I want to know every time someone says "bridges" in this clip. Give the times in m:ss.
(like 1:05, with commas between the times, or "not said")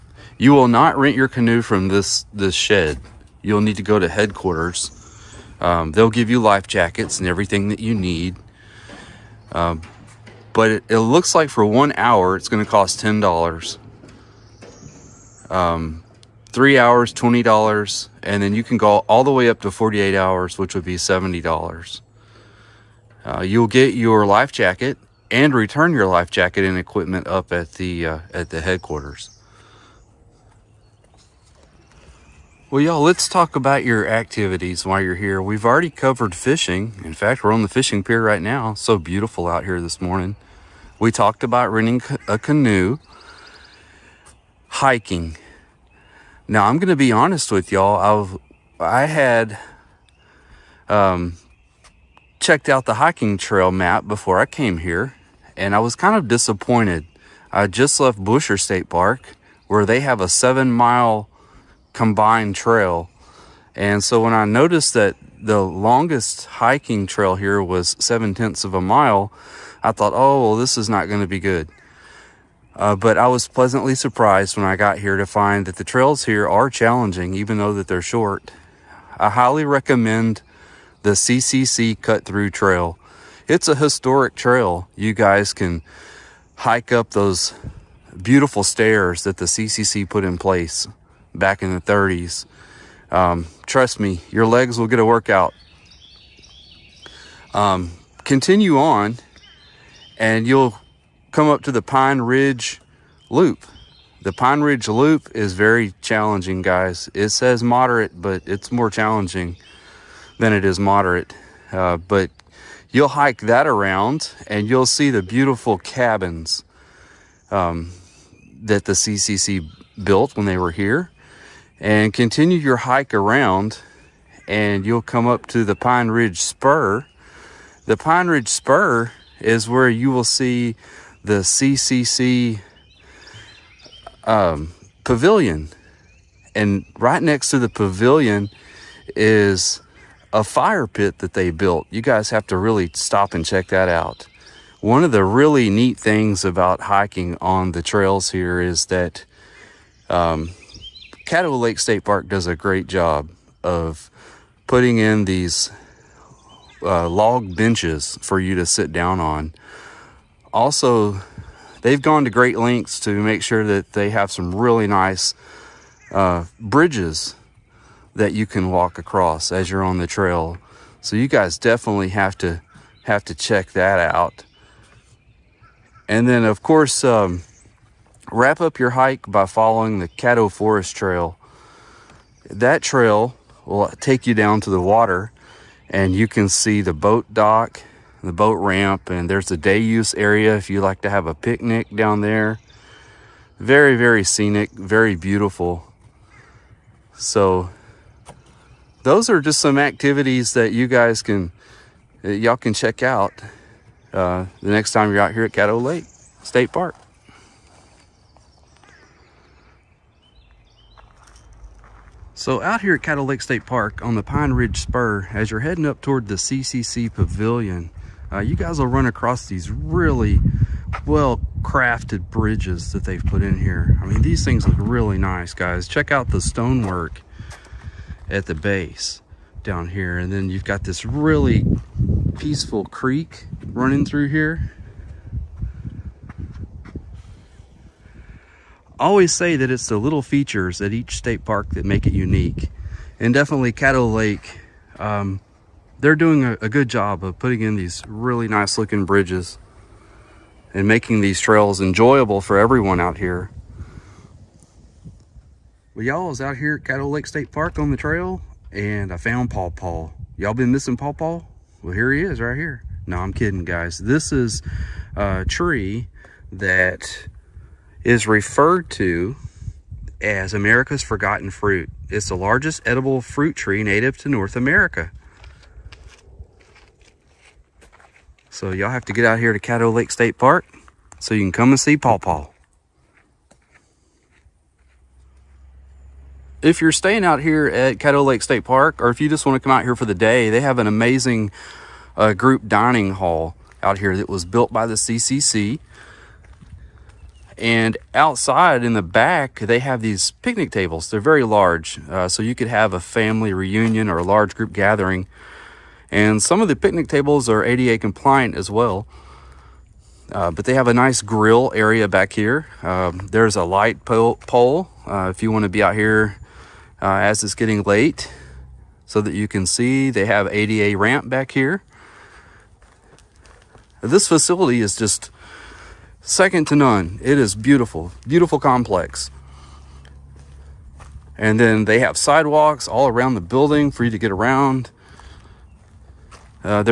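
2:46, 3:42, 4:09.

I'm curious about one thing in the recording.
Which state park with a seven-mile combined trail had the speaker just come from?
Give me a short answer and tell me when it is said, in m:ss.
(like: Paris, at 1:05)
Buescher State Park, at 0:58.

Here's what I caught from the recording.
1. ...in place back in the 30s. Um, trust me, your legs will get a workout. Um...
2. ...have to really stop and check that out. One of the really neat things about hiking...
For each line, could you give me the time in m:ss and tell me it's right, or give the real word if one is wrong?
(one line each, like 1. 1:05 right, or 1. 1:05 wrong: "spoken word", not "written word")
1. 1:30 right
2. 2:22 right.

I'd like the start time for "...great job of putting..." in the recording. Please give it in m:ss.
2:32.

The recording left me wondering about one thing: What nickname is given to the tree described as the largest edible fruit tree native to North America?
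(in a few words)
America's forgotten fruit.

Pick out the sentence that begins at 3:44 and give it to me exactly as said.
I mean, these things look really nice, guys.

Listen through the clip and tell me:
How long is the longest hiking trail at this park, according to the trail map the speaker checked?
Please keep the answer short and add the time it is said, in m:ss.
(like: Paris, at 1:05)
0.7 mile, at 1:08.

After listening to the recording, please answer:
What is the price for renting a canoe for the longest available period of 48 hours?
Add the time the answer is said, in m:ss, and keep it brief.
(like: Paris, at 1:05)
$70, at 0:20.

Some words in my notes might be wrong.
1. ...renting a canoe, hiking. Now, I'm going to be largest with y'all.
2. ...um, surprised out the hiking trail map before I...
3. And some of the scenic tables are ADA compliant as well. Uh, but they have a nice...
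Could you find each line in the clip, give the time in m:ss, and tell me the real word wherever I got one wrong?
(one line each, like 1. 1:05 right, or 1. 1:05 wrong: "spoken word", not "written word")
1. 0:41 wrong: "honest", not "largest"
2. 0:50 wrong: "checked", not "surprised"
3. 5:06 wrong: "picnic", not "scenic".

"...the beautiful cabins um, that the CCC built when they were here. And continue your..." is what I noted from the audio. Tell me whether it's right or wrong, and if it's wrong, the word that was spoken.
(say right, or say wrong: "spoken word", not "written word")
right.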